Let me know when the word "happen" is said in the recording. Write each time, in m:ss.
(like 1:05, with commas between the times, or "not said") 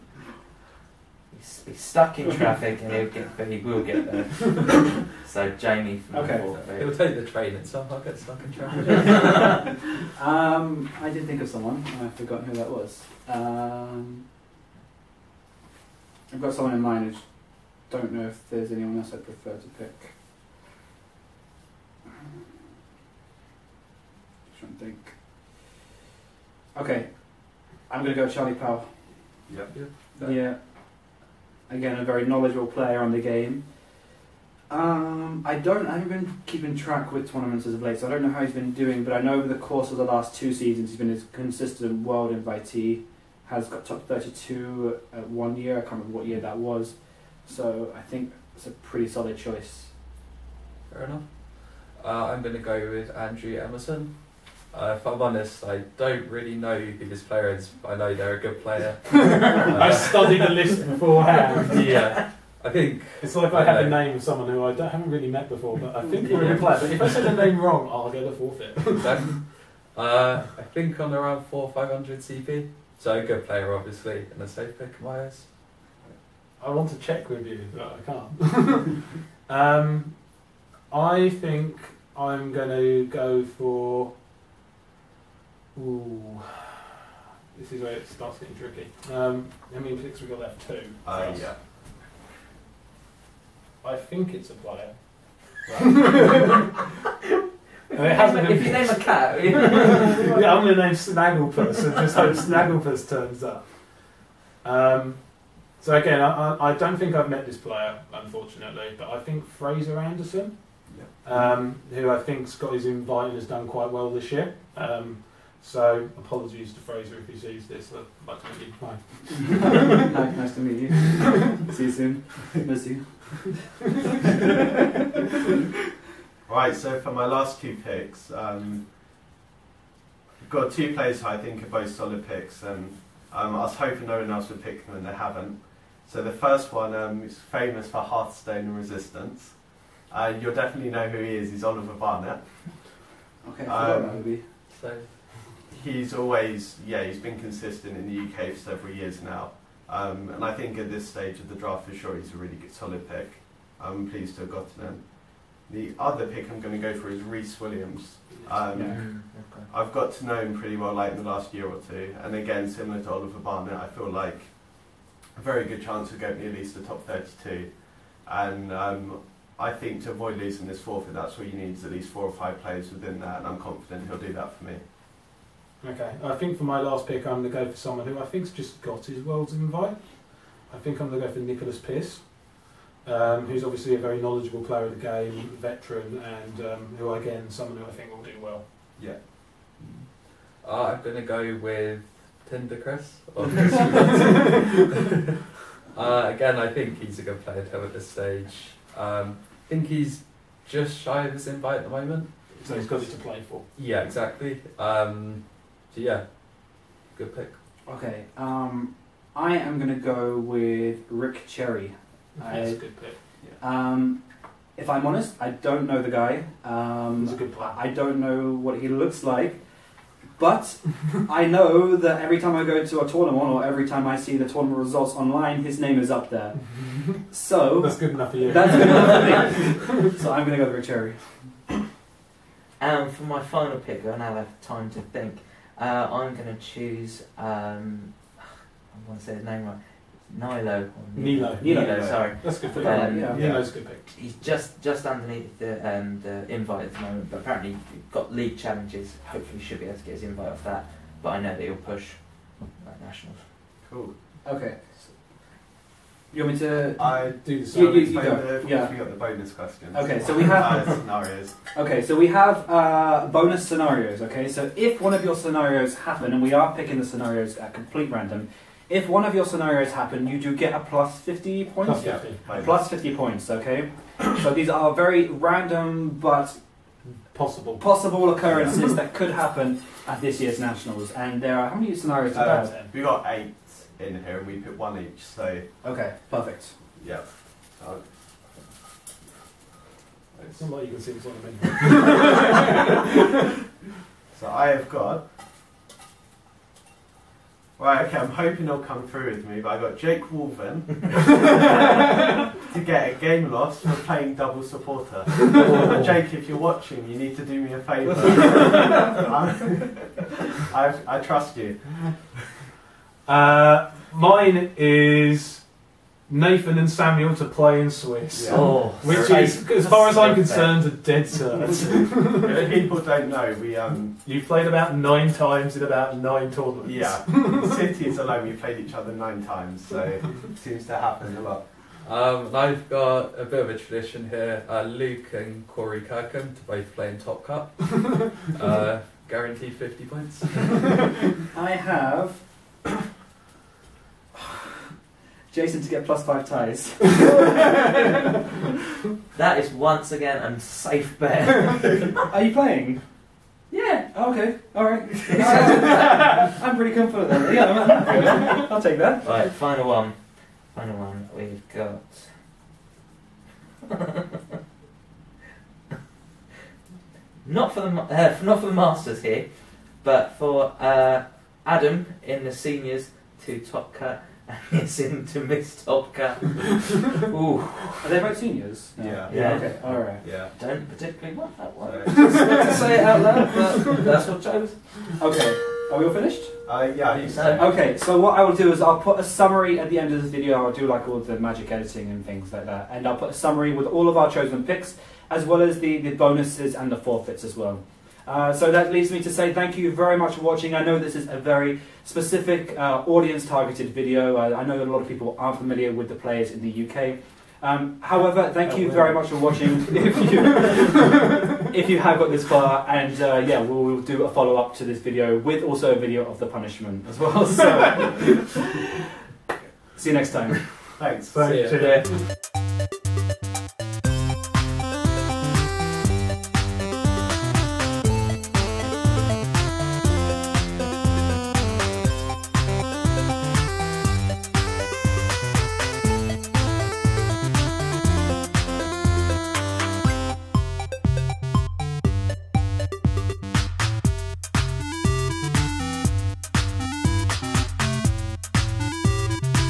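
4:25, 4:29, 4:39, 5:30.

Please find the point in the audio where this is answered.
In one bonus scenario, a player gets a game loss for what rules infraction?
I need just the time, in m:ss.
5:04.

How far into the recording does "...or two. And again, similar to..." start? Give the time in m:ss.
2:41.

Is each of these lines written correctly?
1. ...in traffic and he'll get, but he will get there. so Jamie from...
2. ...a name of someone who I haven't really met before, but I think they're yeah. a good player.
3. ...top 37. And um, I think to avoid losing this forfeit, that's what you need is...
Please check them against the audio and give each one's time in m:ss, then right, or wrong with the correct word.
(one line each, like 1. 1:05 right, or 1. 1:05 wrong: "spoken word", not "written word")
1. 0:02 right
2. 1:03 right
3. 2:46 wrong: "32", not "37".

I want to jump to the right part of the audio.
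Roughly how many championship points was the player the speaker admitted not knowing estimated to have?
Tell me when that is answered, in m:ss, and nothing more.
1:11.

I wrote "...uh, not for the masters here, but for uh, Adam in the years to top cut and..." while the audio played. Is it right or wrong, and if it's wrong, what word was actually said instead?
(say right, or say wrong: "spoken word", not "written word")
wrong: "seniors", not "years".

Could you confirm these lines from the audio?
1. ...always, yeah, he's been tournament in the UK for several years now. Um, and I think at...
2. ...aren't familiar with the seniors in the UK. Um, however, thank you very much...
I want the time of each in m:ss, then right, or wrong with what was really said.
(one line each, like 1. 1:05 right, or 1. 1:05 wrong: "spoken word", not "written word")
1. 2:26 wrong: "consistent", not "tournament"
2. 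6:45 wrong: "players", not "seniors".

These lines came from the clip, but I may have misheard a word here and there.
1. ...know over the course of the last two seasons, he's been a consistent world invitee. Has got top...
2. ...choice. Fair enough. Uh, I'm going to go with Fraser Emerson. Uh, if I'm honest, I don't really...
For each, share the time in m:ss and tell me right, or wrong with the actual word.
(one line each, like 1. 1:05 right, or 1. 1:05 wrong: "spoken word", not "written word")
1. 0:39 right
2. 0:49 wrong: "Andrew", not "Fraser".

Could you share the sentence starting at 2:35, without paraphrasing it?
The other pick I'm going to go for is Reese Williams.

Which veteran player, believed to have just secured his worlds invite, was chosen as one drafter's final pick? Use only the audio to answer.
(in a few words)
Nicholas Pierce.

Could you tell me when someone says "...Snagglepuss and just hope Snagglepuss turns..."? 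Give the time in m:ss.
1:40.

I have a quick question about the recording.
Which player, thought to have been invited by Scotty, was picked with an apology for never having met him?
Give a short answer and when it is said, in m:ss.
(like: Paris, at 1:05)
Fraser Anderson, at 1:49.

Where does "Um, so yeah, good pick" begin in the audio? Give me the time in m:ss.
3:24.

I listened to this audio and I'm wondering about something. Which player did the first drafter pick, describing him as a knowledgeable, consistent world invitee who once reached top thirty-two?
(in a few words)
Charlie Powell.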